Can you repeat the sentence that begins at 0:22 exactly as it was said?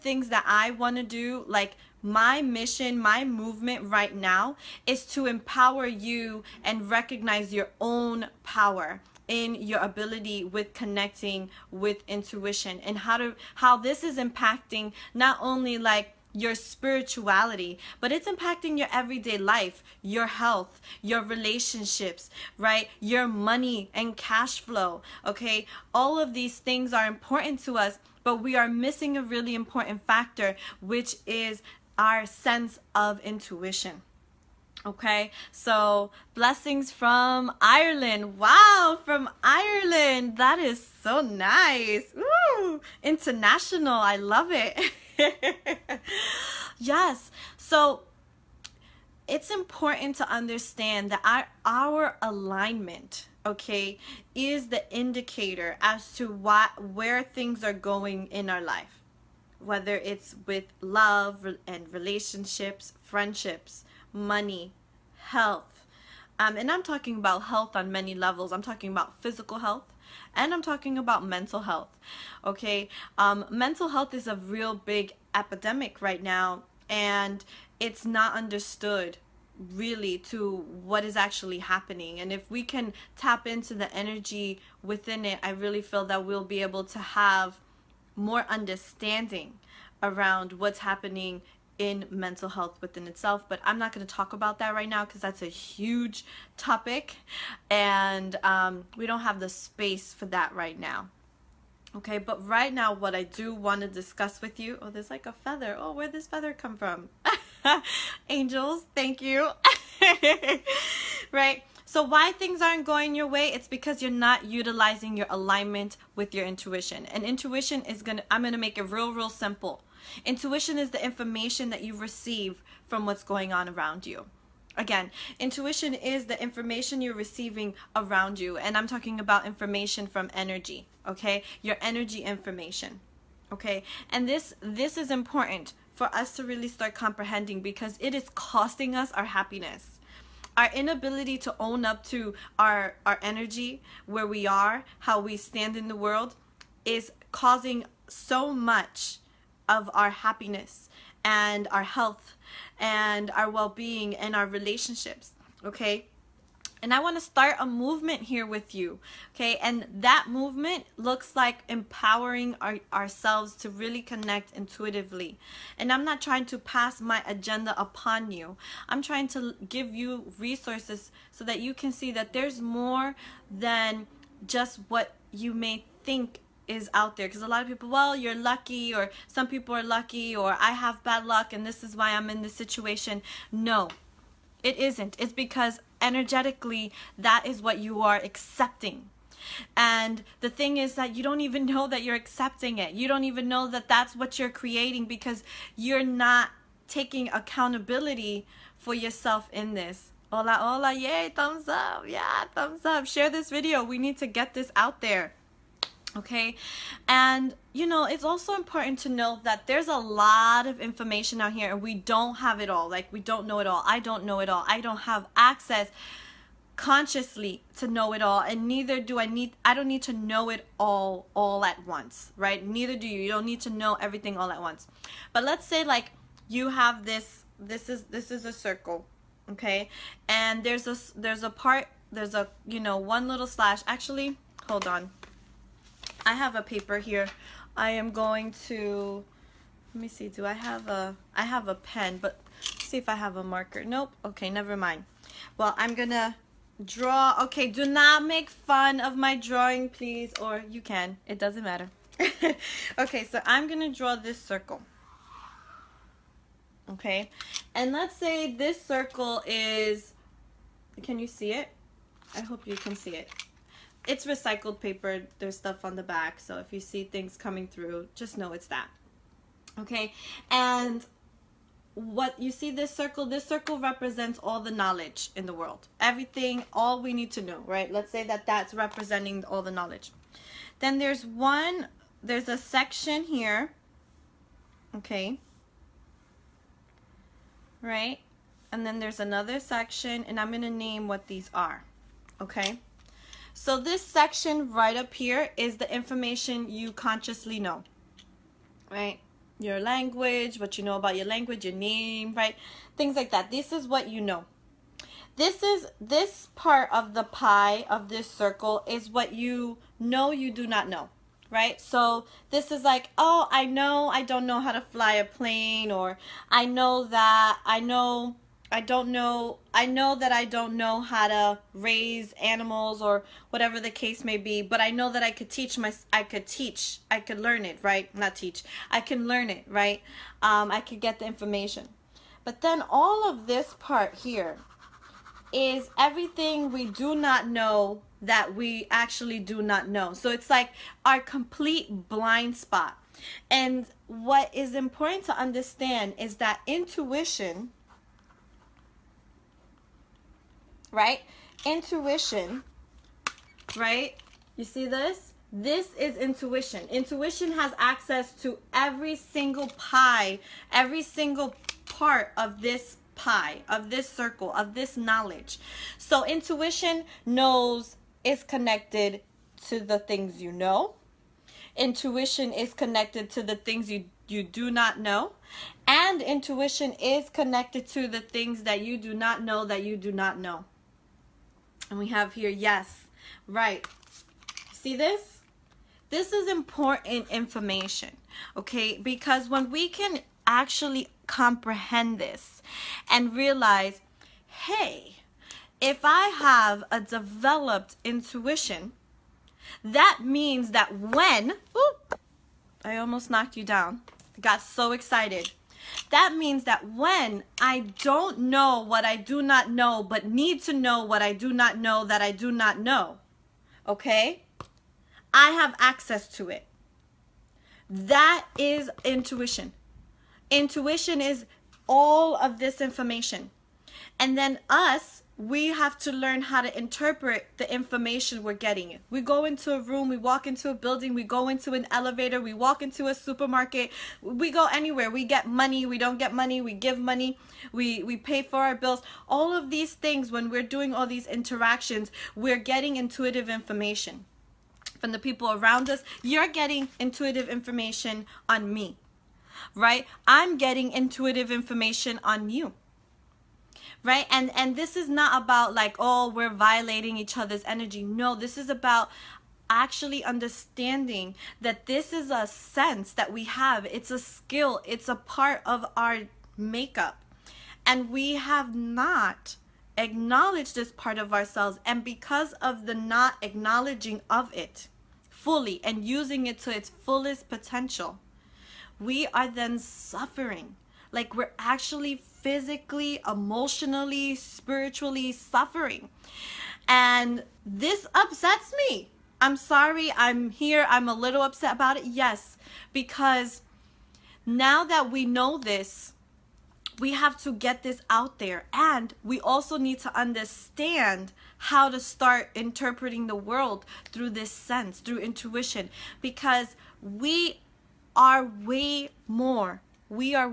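Your money and cash flow, okay?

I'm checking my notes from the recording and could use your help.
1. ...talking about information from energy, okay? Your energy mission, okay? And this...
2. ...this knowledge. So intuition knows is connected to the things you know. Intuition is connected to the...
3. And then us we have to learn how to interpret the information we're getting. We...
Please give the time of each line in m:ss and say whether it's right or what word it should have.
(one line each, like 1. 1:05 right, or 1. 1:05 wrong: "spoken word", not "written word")
1. 2:08 wrong: "information", not "mission"
2. 6:04 right
3. 7:04 right.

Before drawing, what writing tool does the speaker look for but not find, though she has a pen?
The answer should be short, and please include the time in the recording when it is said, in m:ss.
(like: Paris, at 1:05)
A marker, at 4:03.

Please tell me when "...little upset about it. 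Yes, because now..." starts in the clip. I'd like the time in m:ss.
8:11.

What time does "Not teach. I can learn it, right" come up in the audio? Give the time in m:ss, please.
5:28.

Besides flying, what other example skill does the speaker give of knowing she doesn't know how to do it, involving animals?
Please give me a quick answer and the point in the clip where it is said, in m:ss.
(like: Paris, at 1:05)
Raise animals, at 5:21.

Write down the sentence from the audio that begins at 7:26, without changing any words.
You're getting intuitive information on me, right?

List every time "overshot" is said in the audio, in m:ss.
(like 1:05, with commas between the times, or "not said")
not said.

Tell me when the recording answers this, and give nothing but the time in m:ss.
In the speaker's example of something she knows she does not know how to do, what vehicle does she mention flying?
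5:15.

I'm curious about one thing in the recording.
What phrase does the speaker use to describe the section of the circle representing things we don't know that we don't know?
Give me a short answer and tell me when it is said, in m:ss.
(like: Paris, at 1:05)
Complete blind spot, at 5:41.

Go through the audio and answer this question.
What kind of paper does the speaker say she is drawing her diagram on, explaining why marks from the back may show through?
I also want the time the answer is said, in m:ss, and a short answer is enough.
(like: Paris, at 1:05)
Recycled paper, at 4:24.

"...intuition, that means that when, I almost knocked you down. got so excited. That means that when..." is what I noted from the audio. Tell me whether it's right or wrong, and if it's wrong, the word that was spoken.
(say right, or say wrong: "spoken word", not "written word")
right.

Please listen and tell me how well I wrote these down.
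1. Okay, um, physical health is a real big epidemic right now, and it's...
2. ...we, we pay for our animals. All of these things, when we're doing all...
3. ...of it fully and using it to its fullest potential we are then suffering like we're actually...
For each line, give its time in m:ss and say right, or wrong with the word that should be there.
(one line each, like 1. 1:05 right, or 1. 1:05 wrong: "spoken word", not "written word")
1. 1:12 wrong: "mental", not "physical"
2. 7:17 wrong: "bills", not "animals"
3. 7:54 right.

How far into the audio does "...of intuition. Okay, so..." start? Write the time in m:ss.
0:32.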